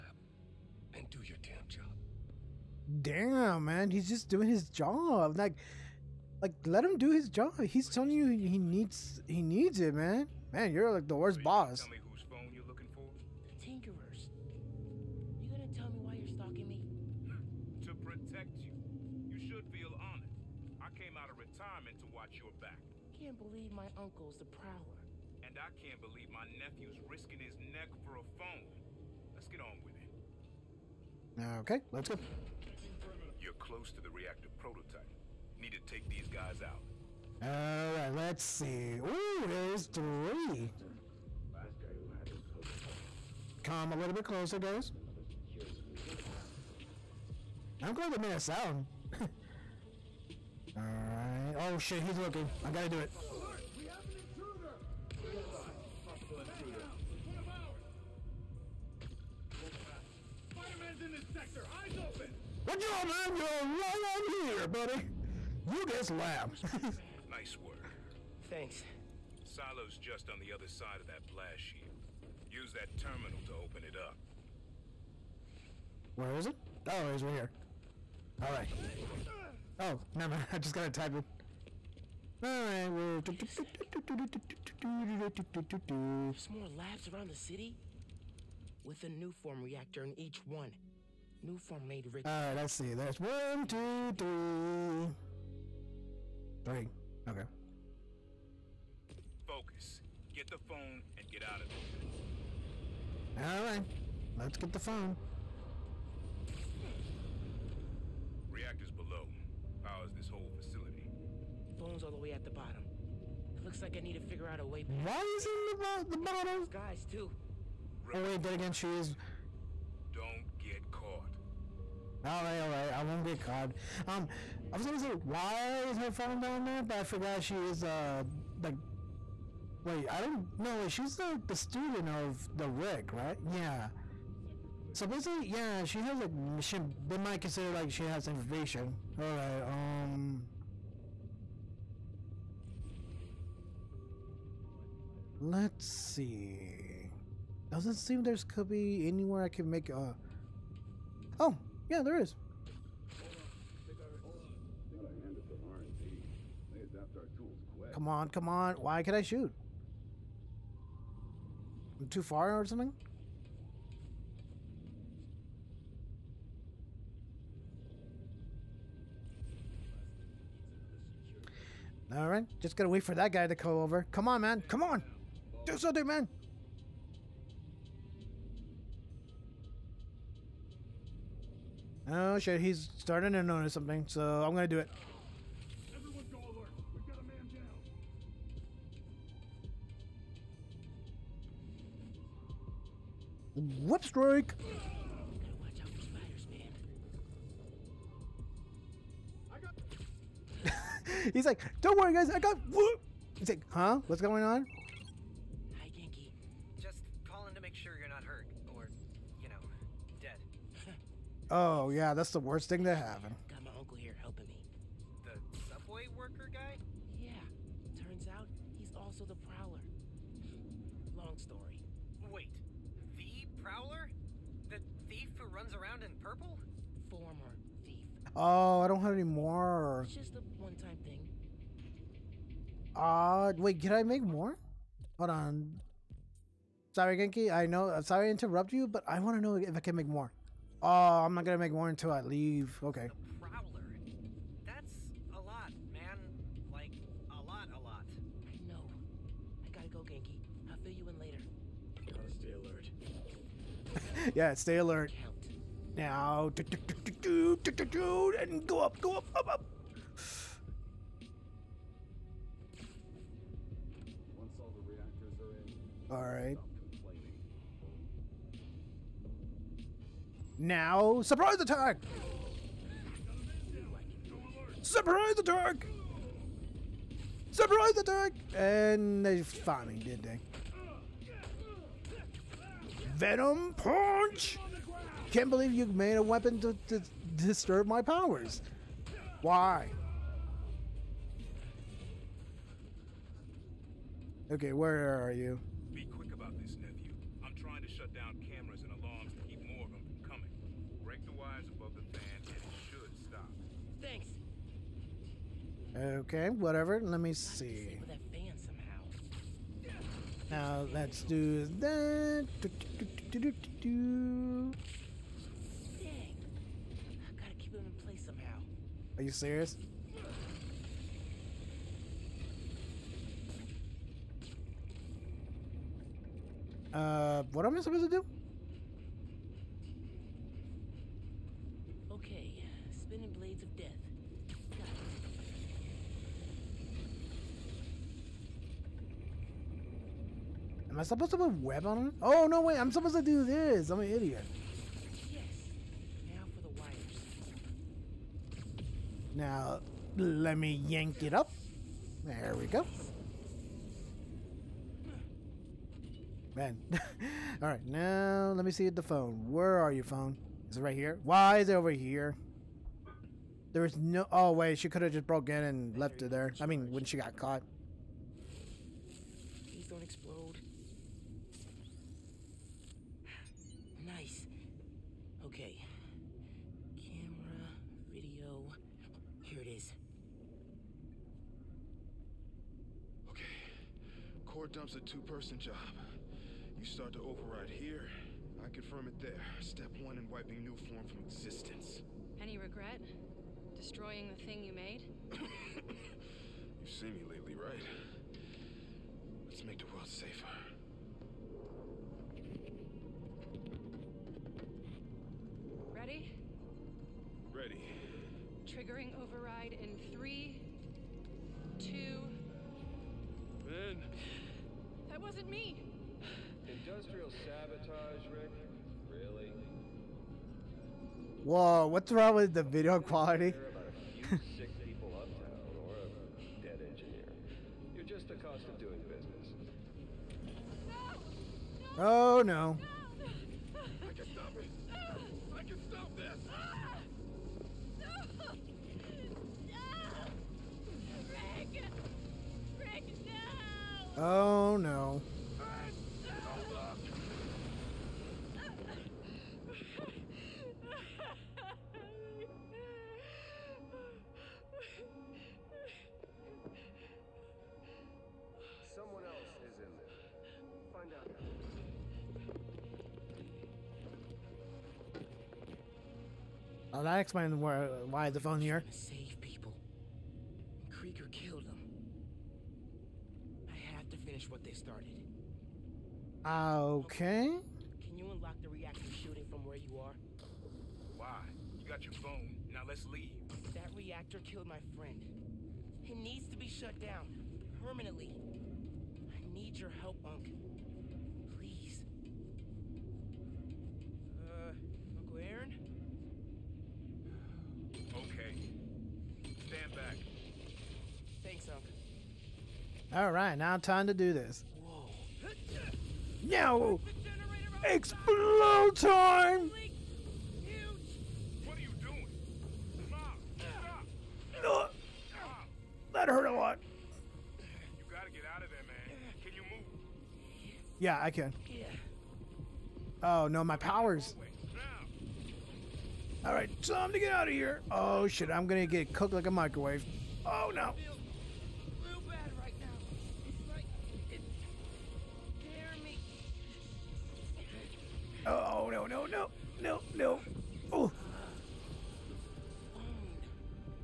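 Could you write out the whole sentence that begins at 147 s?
Doesn't seem there's could be anywhere I can make a.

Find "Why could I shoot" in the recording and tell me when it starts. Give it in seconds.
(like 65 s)
158 s.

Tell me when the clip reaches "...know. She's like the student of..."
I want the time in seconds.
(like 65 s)
130 s.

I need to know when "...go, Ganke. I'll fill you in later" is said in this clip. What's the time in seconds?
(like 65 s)
249 s.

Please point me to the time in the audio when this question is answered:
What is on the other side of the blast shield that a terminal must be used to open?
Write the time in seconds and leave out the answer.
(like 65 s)
69 s.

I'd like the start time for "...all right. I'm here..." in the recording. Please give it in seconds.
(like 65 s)
63 s.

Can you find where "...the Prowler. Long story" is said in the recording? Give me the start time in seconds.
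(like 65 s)
219 s.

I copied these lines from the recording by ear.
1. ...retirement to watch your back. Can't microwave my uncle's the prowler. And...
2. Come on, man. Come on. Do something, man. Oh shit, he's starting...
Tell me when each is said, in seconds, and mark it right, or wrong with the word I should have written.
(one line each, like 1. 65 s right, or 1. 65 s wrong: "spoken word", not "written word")
1. 21 s wrong: "believe", not "microwave"
2. 174 s right.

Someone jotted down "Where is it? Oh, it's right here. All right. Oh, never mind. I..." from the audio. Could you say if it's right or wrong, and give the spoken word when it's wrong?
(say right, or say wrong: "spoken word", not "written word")
right.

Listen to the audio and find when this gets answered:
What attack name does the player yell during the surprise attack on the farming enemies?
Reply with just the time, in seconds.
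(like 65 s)
283 s.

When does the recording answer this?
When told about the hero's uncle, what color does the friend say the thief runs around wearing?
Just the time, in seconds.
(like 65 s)
226 s.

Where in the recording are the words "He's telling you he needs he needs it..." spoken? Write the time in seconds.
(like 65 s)
7 s.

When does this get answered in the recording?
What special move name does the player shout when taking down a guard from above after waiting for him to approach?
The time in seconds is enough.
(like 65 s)
193 s.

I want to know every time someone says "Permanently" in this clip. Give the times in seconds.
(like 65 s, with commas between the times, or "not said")
487 s.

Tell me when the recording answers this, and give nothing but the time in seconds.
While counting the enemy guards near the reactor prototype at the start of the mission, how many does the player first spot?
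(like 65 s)
39 s.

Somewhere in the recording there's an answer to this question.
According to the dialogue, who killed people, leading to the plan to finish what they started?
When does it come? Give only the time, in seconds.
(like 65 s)
470 s.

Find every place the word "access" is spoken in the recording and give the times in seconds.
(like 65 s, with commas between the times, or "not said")
not said.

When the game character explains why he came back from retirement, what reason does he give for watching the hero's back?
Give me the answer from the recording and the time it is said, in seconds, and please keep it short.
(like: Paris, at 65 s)
to protect you, at 17 s.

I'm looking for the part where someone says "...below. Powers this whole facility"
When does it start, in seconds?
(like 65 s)
108 s.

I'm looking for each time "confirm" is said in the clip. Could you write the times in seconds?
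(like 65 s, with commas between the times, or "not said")
388 s.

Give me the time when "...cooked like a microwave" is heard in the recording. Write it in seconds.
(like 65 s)
529 s.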